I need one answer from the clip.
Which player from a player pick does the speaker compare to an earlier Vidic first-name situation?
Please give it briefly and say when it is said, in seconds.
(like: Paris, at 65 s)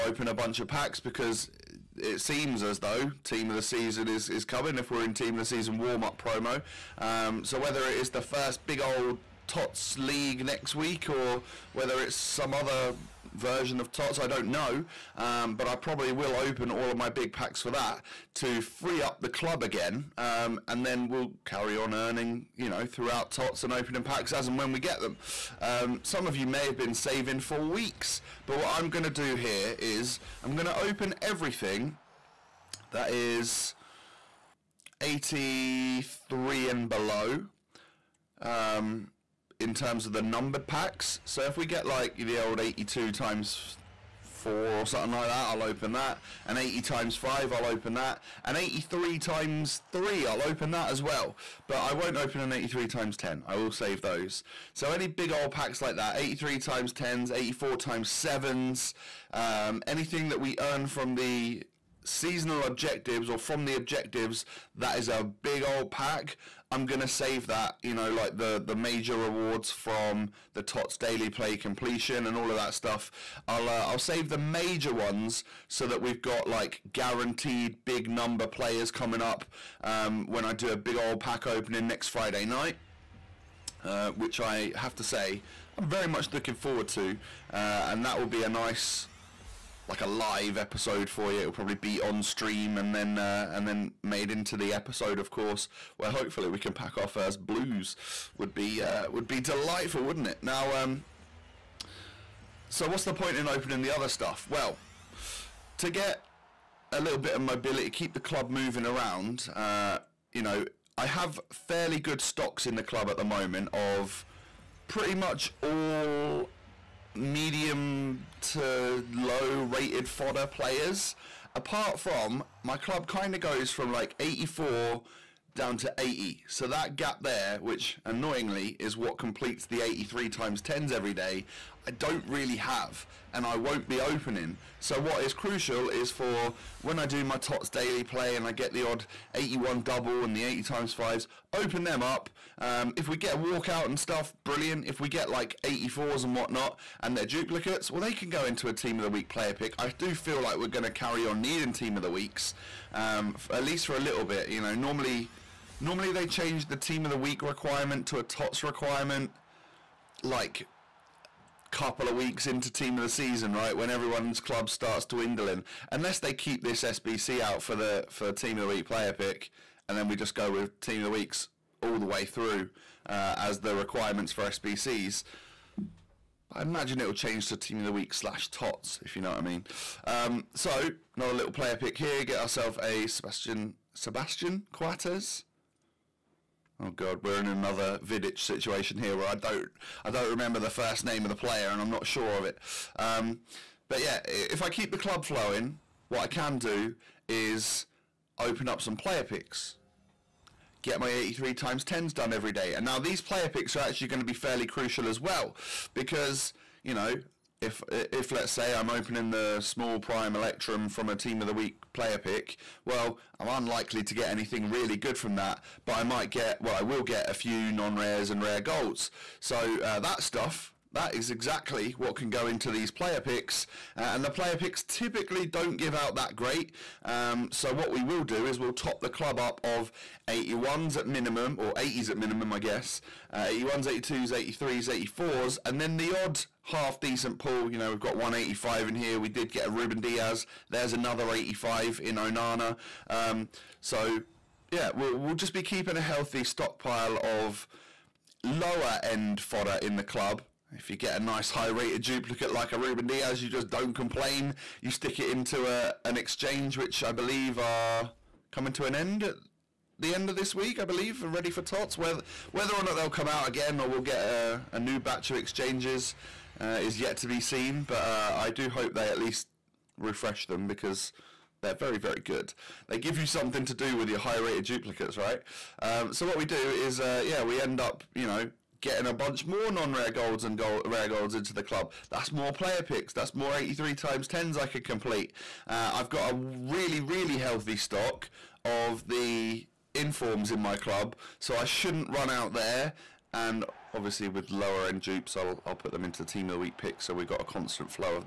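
Sebastian Coates, at 183 s.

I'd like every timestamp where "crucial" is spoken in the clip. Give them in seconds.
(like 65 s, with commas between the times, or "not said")
135 s, 204 s.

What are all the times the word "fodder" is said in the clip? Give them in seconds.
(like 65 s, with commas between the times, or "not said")
120 s, 249 s.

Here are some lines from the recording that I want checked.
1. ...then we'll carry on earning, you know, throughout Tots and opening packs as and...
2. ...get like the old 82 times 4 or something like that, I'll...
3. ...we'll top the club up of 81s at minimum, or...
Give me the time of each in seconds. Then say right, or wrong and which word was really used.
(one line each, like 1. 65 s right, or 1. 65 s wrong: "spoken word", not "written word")
1. 20 s right
2. 41 s right
3. 228 s right.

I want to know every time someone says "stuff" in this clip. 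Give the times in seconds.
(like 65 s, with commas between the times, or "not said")
72 s, 104 s, 143 s, 220 s.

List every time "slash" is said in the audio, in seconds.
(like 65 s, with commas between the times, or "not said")
178 s.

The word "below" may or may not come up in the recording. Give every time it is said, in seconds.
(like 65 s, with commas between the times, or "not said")
36 s.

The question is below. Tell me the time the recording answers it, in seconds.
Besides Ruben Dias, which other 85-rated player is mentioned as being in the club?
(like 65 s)
242 s.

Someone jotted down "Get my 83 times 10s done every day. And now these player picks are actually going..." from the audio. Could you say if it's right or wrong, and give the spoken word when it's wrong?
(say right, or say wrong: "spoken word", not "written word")
right.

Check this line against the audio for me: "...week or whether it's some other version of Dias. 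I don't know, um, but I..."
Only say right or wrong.
wrong.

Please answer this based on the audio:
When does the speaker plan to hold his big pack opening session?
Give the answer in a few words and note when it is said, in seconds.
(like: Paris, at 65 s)
next Friday night, at 81 s.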